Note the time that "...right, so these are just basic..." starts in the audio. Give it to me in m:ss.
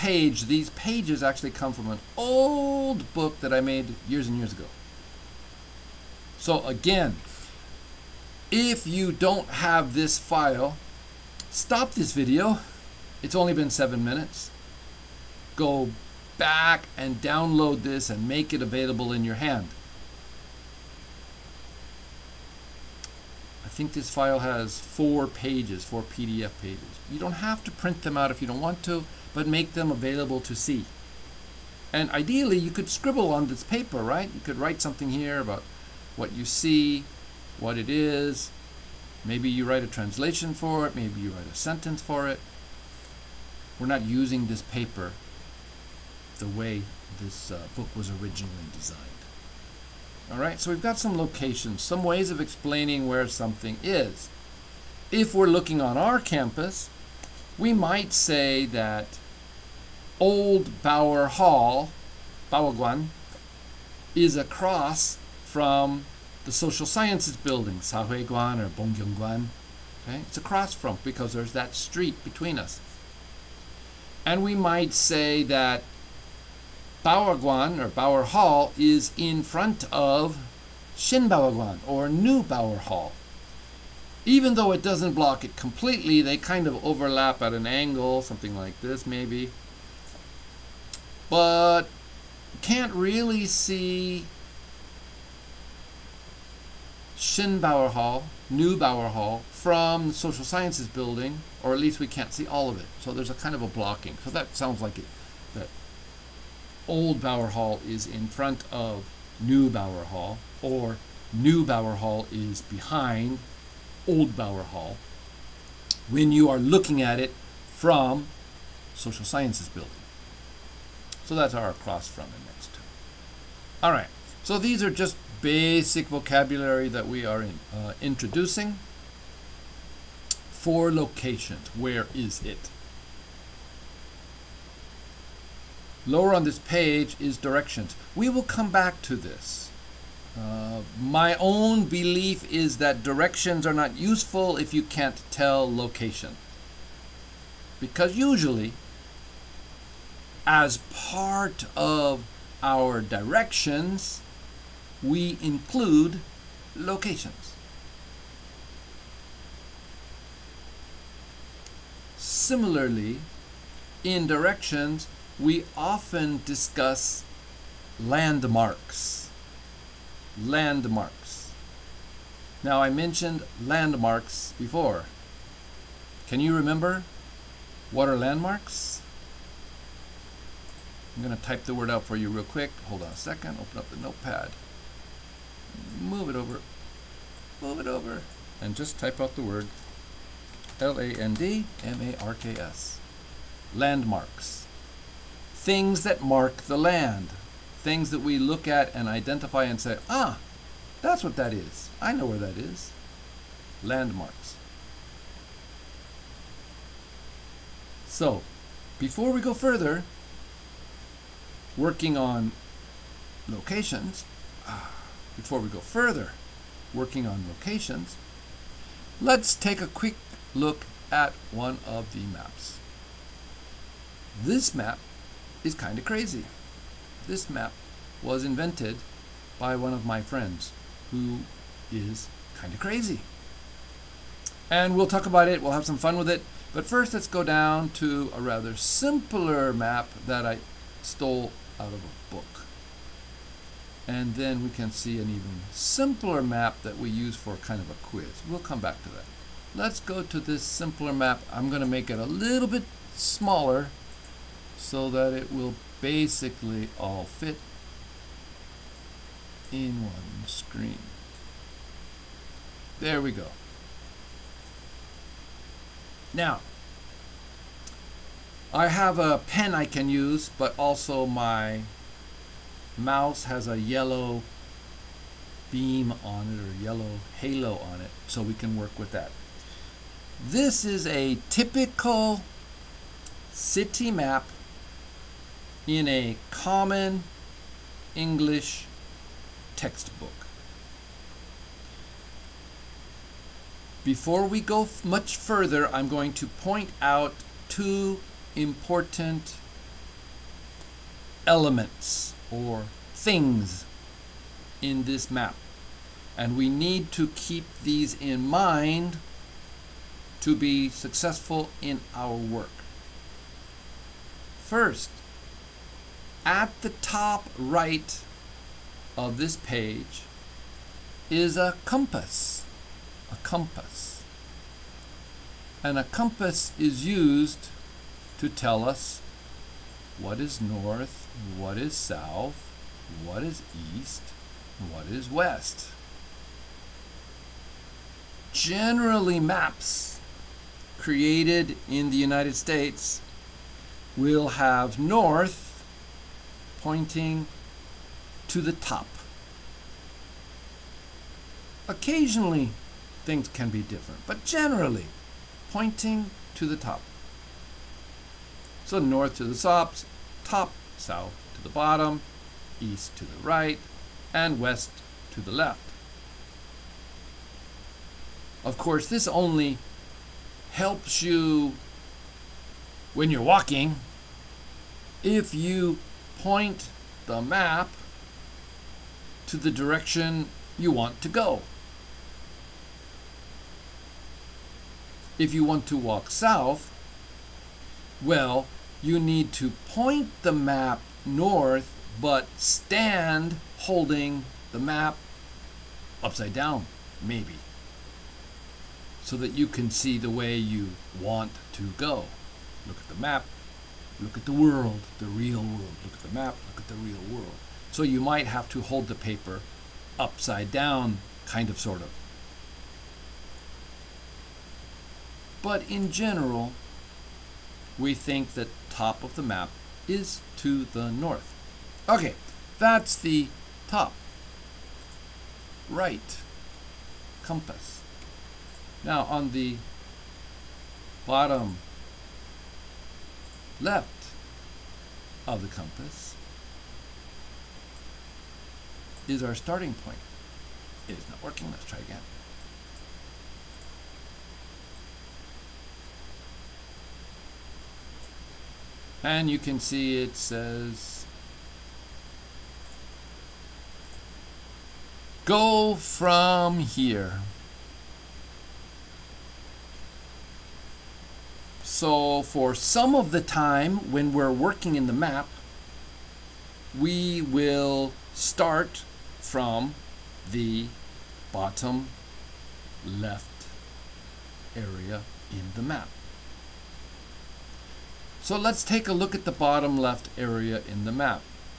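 2:03.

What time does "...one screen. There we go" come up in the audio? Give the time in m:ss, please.
4:20.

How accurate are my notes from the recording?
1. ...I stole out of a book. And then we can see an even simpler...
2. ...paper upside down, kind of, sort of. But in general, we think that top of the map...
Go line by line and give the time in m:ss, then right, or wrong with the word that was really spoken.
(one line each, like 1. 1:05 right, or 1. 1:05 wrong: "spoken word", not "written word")
1. 4:00 right
2. 6:49 right.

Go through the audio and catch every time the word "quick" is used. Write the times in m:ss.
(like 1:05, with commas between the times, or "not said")
3:02, 3:39.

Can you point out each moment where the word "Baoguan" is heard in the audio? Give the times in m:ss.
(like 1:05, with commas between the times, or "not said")
1:02, 1:21.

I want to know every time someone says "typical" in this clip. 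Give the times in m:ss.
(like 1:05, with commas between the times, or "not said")
4:41.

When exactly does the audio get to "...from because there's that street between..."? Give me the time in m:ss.
1:10.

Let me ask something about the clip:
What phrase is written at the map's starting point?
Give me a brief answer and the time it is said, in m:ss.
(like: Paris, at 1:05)
Go from here, at 7:35.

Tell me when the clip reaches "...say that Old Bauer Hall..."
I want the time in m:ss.
0:58.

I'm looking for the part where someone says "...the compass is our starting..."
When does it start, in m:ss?
7:15.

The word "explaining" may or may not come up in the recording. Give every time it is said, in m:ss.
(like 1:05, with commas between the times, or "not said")
0:52.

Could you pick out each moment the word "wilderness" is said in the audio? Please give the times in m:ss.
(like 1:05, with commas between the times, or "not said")
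not said.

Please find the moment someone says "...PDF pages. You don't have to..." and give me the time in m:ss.
0:26.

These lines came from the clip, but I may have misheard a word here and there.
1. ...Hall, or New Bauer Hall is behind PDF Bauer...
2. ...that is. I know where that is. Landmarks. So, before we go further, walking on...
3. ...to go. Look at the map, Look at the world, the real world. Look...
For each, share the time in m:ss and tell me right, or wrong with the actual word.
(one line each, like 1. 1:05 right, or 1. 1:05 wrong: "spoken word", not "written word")
1. 1:50 wrong: "Old", not "PDF"
2. 3:21 wrong: "working", not "walking"
3. 6:41 right.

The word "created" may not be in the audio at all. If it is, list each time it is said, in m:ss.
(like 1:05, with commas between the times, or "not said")
5:40.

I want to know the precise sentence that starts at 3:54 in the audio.
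And we'll talk about it, we'll have some fun with it.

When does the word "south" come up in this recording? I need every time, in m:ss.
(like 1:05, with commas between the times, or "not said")
5:31, 6:00, 6:26.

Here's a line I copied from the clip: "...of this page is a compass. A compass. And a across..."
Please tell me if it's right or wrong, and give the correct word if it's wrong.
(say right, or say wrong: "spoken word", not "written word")
wrong: "compass", not "across".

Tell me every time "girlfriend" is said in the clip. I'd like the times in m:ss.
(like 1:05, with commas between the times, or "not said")
not said.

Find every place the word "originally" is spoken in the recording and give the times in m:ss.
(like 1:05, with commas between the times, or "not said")
0:48.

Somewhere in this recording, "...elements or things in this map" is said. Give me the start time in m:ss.
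5:01.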